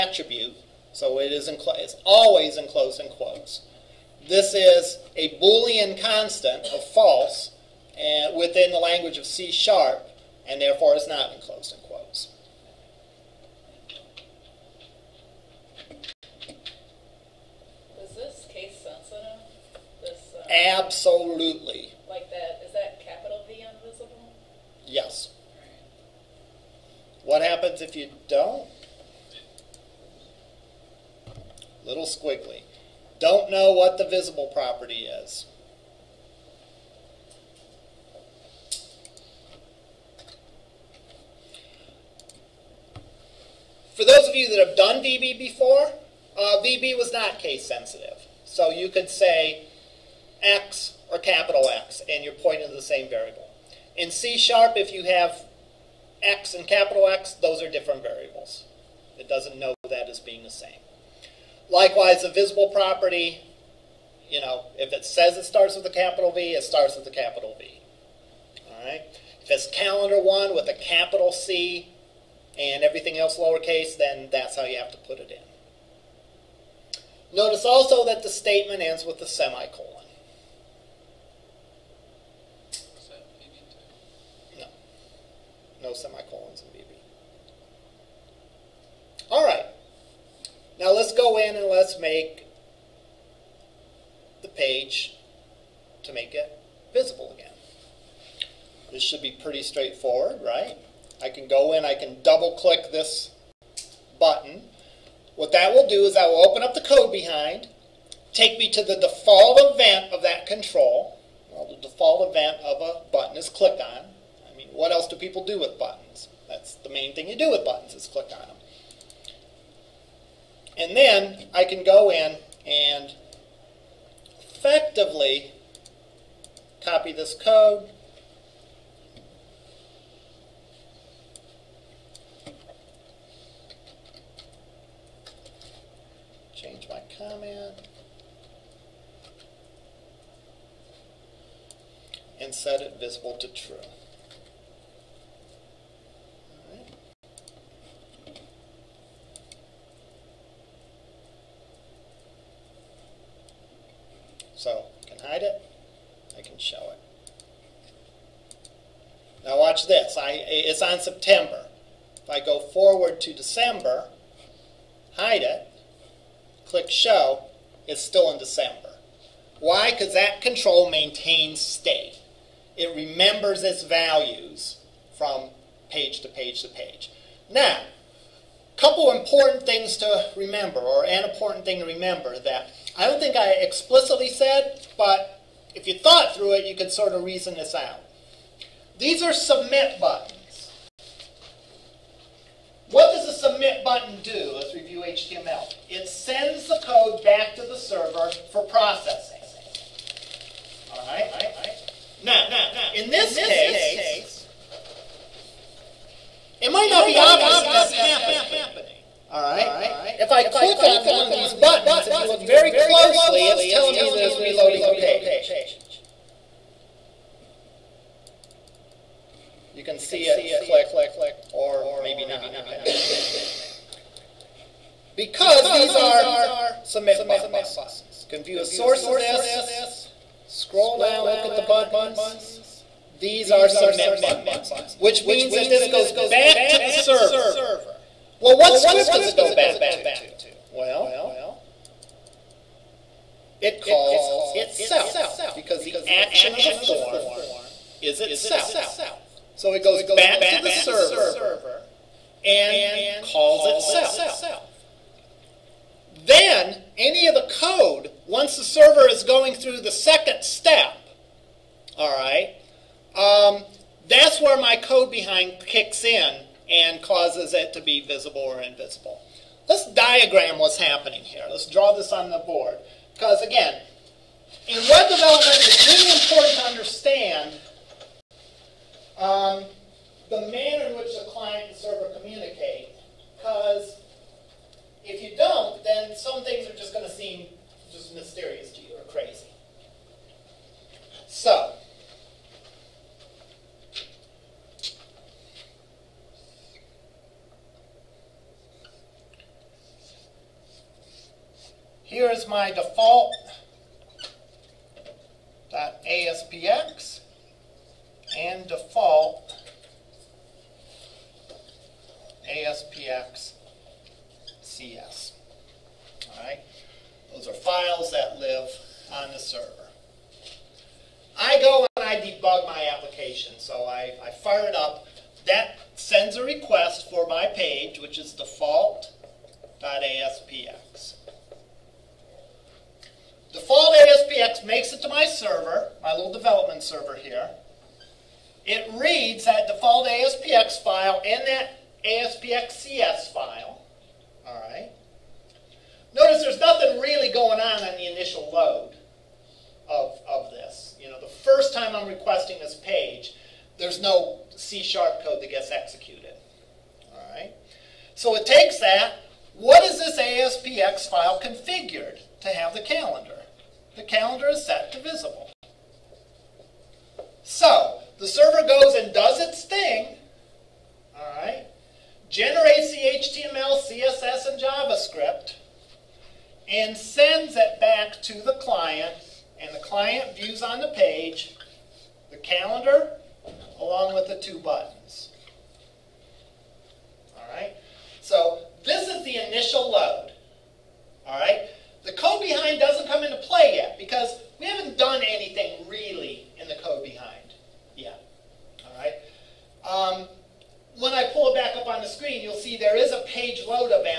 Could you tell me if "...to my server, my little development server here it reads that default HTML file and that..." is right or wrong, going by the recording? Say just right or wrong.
wrong.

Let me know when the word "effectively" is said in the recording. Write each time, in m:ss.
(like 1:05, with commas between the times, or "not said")
2:04.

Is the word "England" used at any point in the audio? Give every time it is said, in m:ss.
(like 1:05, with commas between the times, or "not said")
not said.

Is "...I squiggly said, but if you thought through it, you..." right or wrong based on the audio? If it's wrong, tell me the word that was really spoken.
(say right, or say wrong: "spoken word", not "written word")
wrong: "explicitly", not "squiggly".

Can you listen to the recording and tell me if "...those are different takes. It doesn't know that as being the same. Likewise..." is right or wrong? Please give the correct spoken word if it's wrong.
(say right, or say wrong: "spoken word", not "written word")
wrong: "variables", not "takes".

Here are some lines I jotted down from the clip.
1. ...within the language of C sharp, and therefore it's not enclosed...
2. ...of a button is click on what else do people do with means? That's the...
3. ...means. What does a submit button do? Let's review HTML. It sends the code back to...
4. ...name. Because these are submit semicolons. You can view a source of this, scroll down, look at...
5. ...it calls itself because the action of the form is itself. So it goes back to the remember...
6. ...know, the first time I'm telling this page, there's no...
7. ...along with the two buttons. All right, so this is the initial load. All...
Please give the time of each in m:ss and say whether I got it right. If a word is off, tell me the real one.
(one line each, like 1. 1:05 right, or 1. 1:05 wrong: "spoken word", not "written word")
1. 0:08 right
2. 1:52 wrong: "buttons", not "means"
3. 3:09 wrong: "buttons", not "means"
4. 3:43 wrong: "buttons", not "semicolons"
5. 4:03 wrong: "server", not "remember"
6. 5:51 wrong: "requesting", not "telling"
7. 6:23 right.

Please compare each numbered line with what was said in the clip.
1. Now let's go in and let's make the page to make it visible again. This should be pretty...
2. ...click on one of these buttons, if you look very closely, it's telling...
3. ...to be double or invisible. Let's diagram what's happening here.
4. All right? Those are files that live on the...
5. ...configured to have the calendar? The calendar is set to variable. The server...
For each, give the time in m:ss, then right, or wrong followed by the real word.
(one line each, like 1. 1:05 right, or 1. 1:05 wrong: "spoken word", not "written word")
1. 1:30 right
2. 3:30 right
3. 4:27 wrong: "visible", not "double"
4. 5:16 right
5. 6:01 wrong: "visible", not "variable".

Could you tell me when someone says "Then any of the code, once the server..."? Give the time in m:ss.
4:16.